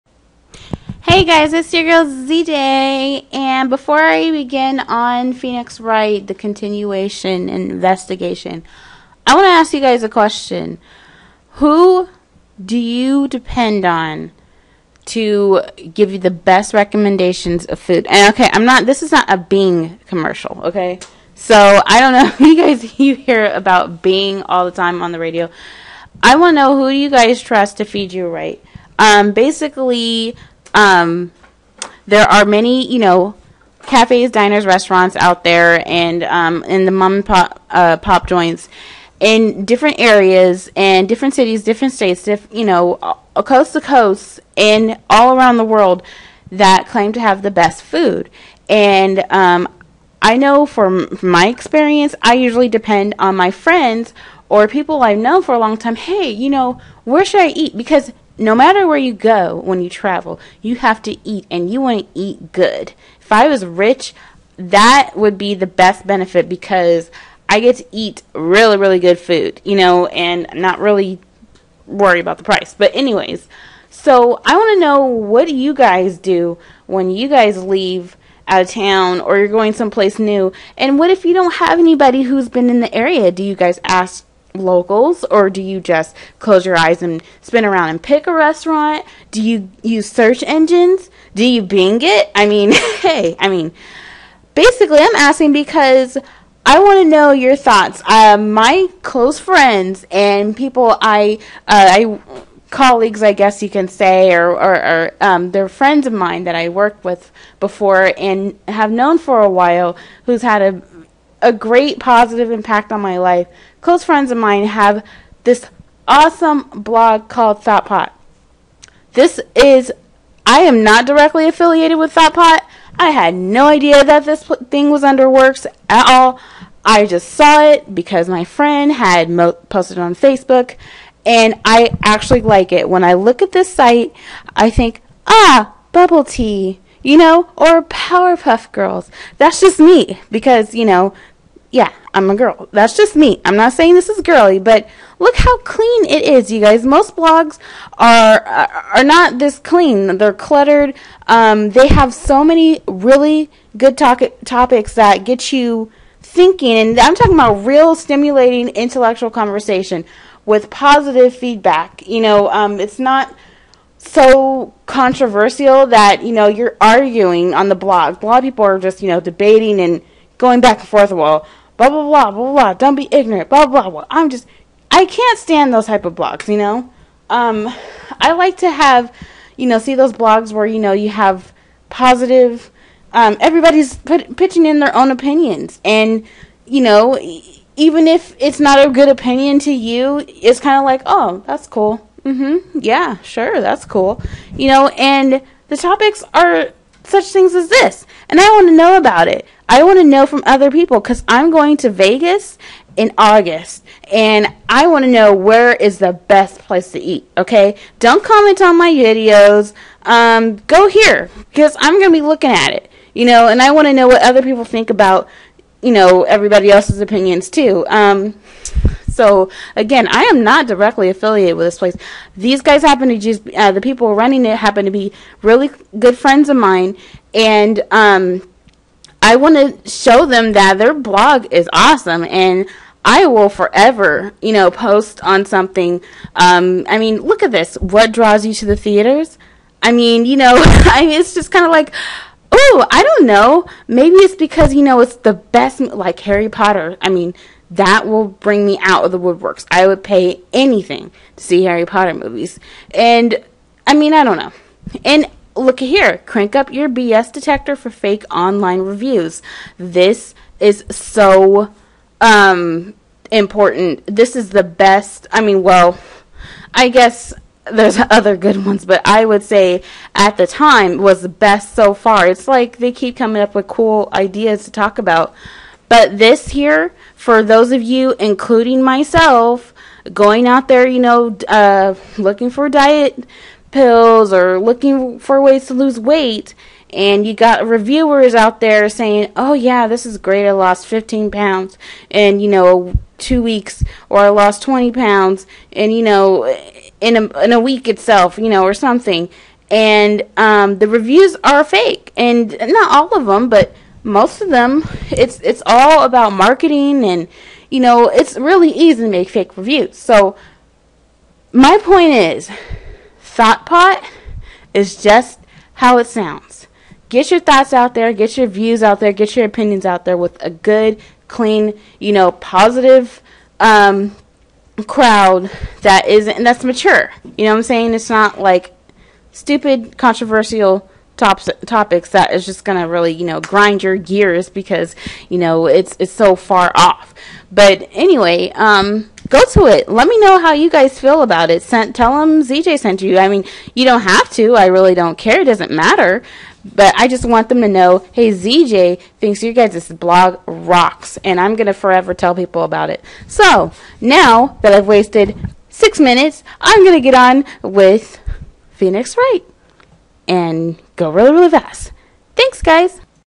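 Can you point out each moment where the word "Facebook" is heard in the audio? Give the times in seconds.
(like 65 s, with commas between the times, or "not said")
130 s.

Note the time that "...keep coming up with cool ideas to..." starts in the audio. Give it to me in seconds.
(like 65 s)
272 s.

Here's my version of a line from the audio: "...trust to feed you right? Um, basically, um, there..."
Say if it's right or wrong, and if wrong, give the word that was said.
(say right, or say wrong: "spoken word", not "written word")
right.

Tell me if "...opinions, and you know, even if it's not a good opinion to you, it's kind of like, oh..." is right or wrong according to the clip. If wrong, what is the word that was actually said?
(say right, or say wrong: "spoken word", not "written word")
right.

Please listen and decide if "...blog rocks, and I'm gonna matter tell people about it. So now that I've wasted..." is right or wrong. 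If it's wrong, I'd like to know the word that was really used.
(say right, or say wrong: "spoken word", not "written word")
wrong: "forever", not "matter".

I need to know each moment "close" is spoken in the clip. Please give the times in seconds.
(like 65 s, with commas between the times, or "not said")
86 s, 99 s, 113 s.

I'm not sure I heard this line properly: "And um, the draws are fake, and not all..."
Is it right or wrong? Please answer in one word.
wrong.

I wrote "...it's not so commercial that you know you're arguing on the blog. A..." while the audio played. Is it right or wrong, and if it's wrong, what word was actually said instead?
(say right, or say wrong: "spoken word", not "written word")
wrong: "controversial", not "commercial".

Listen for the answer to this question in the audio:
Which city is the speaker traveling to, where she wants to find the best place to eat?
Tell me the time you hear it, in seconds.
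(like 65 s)
201 s.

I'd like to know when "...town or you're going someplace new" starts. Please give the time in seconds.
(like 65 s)
78 s.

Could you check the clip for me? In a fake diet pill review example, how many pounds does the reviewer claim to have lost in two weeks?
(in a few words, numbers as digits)
15.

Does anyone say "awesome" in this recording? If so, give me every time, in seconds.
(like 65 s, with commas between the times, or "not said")
116 s, 231 s.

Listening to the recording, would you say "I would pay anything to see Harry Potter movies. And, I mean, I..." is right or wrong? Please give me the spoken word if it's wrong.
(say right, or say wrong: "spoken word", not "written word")
right.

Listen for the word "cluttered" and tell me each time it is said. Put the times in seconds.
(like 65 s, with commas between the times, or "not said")
150 s.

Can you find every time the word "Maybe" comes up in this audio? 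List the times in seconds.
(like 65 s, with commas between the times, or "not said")
243 s.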